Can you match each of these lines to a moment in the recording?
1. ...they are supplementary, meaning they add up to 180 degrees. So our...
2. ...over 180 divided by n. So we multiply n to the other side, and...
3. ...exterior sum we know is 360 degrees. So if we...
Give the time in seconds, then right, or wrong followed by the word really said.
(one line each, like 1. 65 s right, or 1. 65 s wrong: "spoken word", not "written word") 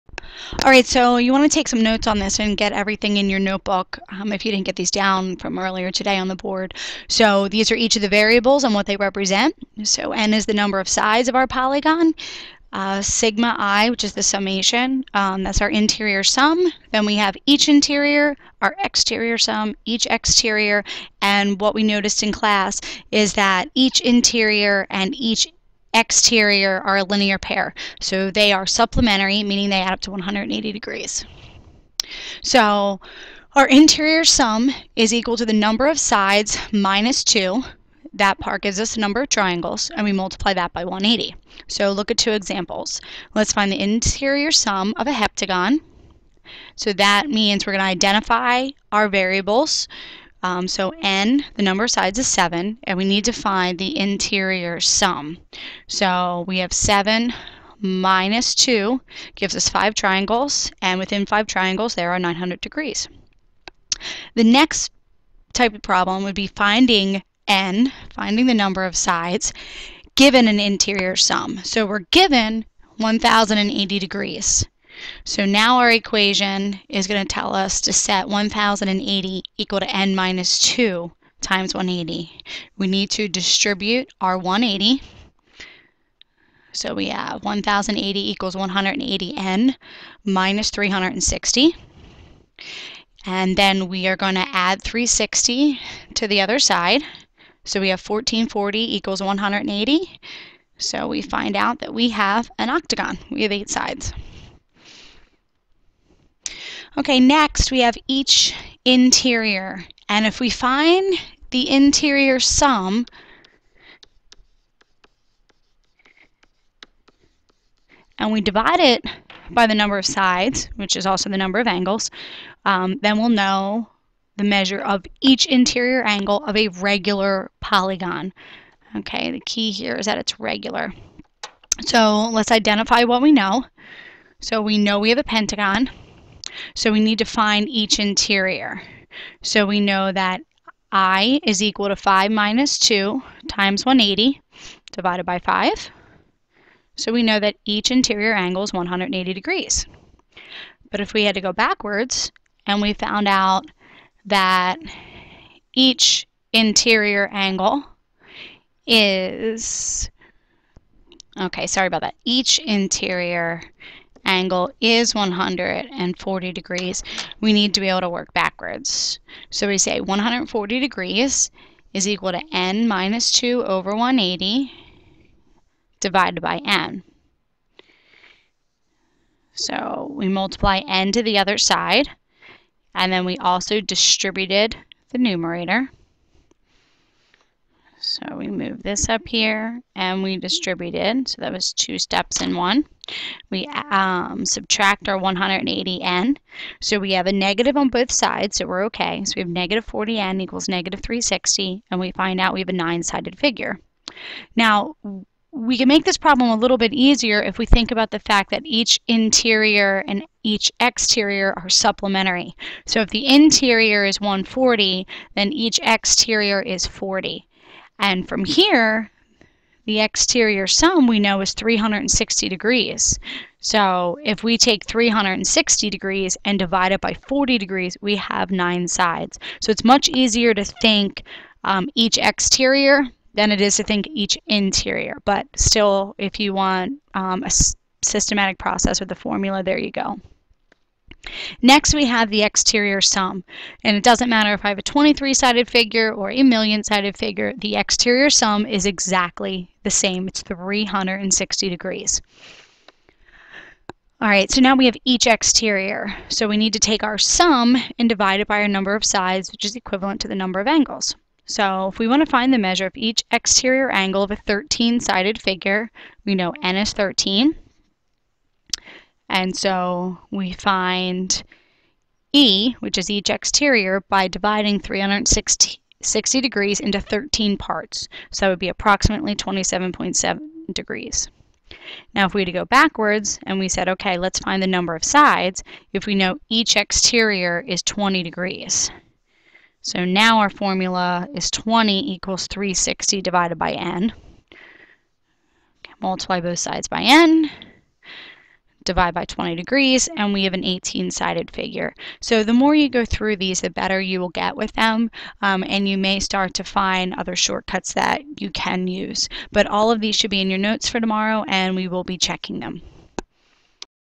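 1. 28 s right
2. 173 s right
3. 219 s right.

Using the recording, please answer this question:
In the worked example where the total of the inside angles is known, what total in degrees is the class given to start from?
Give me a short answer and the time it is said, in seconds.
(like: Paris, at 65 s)
1080, at 72 s.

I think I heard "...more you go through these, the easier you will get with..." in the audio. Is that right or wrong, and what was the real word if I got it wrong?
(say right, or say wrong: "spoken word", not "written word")
wrong: "better", not "easier".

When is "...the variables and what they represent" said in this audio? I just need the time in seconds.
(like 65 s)
8 s.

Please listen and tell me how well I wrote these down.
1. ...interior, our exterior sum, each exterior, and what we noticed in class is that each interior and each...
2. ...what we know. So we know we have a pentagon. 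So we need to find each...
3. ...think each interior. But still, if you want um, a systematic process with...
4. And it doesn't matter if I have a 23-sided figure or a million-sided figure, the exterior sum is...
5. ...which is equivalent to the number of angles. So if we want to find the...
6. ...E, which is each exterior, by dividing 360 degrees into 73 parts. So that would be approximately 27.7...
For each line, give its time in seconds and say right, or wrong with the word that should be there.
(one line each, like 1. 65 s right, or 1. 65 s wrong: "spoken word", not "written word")
1. 17 s right
2. 133 s right
3. 233 s right
4. 243 s right
5. 259 s right
6. 272 s wrong: "13", not "73".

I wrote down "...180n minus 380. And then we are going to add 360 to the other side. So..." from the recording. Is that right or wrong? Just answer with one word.
wrong.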